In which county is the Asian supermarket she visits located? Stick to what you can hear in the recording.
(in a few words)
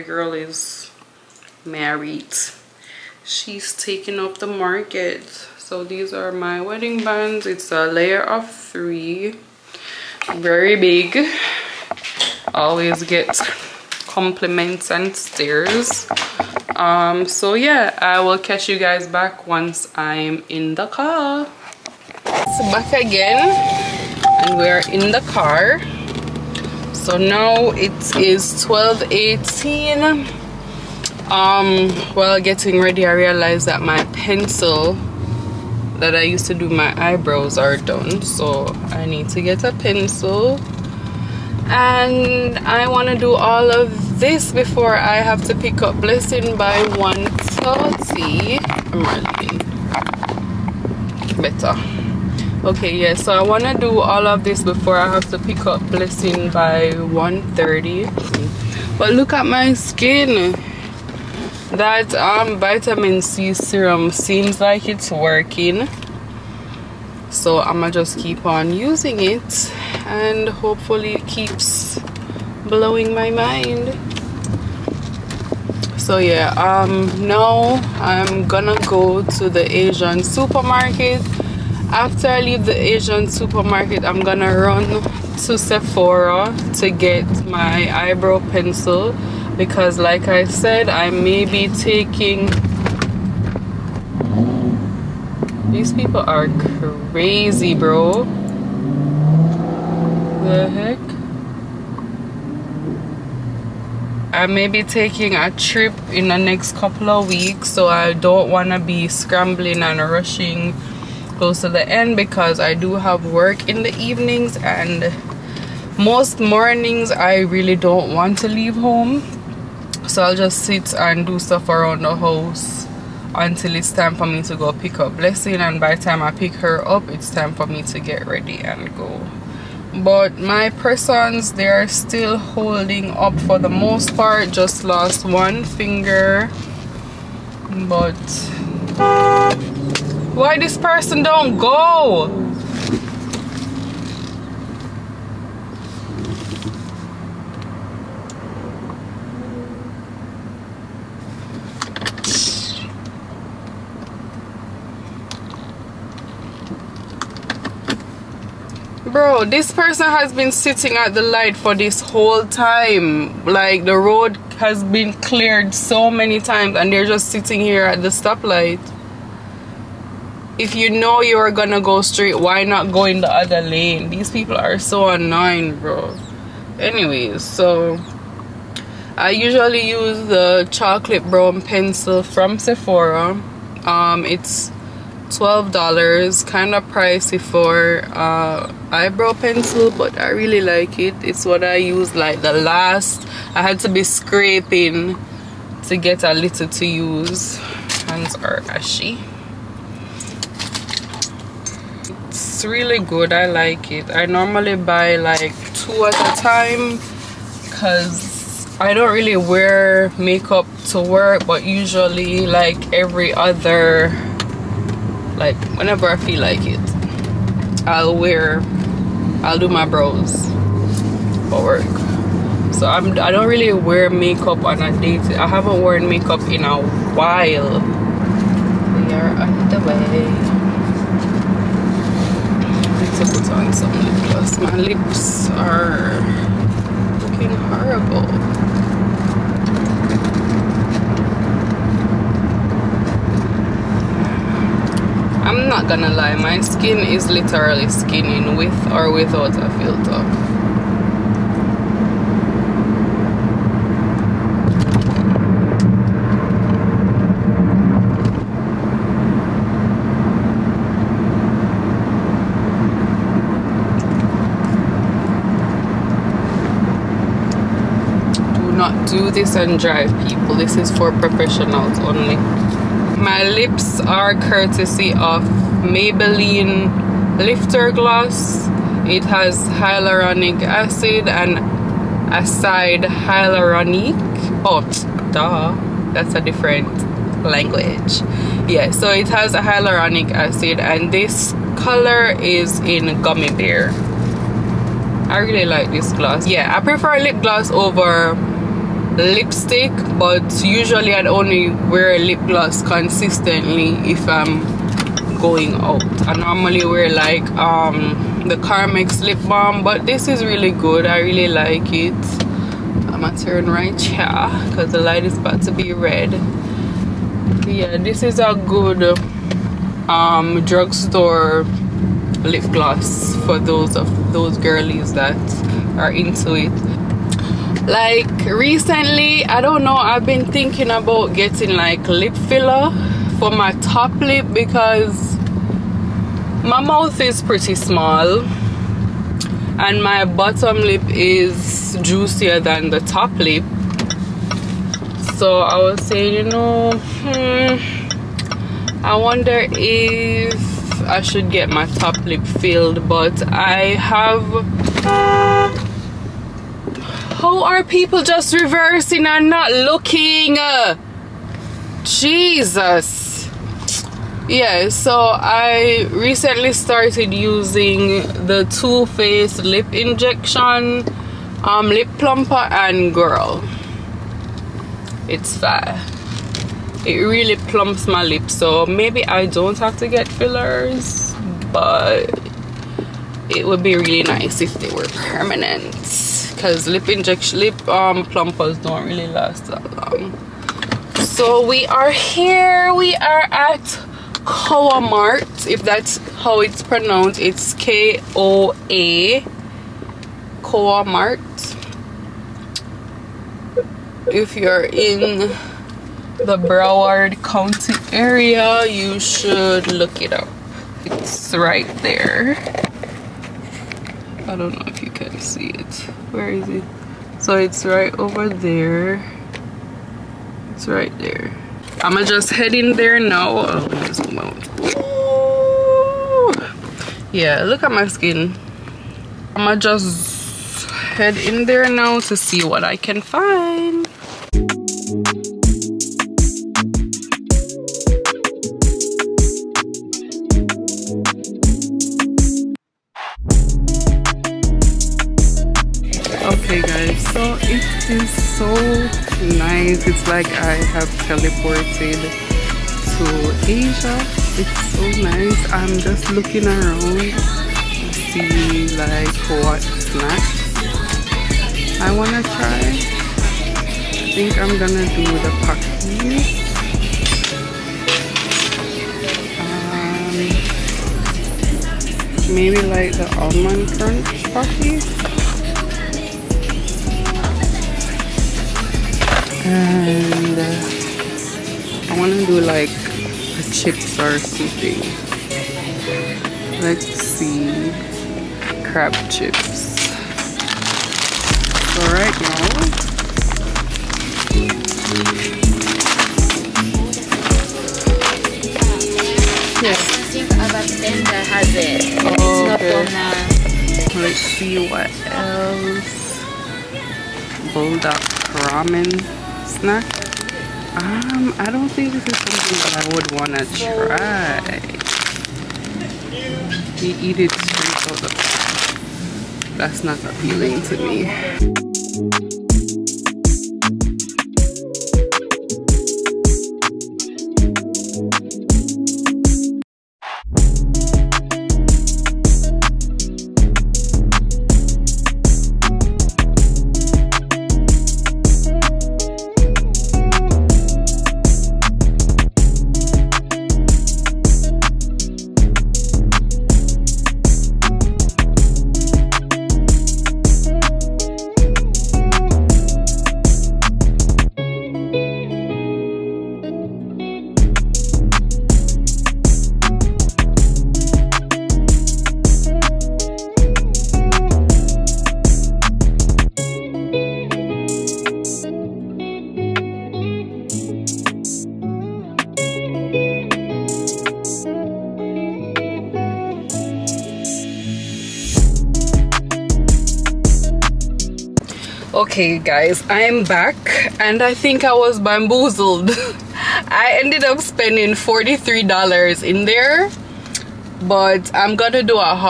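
Broward County.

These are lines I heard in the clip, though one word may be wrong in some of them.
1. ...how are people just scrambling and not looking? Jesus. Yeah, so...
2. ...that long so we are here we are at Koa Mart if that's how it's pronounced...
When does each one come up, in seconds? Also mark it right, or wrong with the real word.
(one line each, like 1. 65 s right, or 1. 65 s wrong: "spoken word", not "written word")
1. 357 s wrong: "reversing", not "scrambling"
2. 389 s right.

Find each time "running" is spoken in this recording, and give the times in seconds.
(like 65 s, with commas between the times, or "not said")
51 s.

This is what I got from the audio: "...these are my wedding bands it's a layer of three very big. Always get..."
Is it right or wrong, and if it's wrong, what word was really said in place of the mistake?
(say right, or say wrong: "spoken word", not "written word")
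right.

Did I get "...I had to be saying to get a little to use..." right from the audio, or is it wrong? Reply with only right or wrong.
wrong.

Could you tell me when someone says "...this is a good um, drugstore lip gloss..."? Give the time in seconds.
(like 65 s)
317 s.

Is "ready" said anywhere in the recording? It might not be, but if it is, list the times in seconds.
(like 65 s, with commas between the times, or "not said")
32 s, 128 s.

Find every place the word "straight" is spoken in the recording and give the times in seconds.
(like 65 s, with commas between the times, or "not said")
172 s, 517 s.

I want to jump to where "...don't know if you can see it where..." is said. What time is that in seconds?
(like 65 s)
414 s.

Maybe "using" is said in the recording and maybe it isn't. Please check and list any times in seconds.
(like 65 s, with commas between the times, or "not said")
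68 s, 367 s.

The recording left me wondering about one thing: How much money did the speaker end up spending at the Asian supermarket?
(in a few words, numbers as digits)
$43.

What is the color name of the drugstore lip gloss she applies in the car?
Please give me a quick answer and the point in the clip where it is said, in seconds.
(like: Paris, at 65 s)
Gummy bear, at 293 s.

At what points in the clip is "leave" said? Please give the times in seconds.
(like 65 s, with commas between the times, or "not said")
82 s, 118 s.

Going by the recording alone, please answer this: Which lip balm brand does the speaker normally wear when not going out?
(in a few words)
Carmex.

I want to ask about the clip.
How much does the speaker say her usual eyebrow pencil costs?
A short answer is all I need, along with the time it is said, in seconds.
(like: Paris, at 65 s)
$12, at 185 s.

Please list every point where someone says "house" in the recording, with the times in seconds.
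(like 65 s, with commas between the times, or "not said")
122 s.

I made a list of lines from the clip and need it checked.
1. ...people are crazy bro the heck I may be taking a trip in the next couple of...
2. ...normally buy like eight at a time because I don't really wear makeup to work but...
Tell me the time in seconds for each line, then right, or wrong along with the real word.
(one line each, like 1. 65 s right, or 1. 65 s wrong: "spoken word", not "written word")
1. 95 s right
2. 204 s wrong: "two", not "eight".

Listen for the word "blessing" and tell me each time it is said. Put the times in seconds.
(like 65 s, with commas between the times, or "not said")
45 s, 55 s, 125 s.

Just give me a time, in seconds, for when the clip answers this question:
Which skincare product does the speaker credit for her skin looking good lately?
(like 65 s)
62 s.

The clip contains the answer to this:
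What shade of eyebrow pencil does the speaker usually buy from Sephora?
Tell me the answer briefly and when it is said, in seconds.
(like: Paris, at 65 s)
Chocolate brown, at 180 s.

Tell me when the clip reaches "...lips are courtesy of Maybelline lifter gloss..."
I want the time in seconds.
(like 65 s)
273 s.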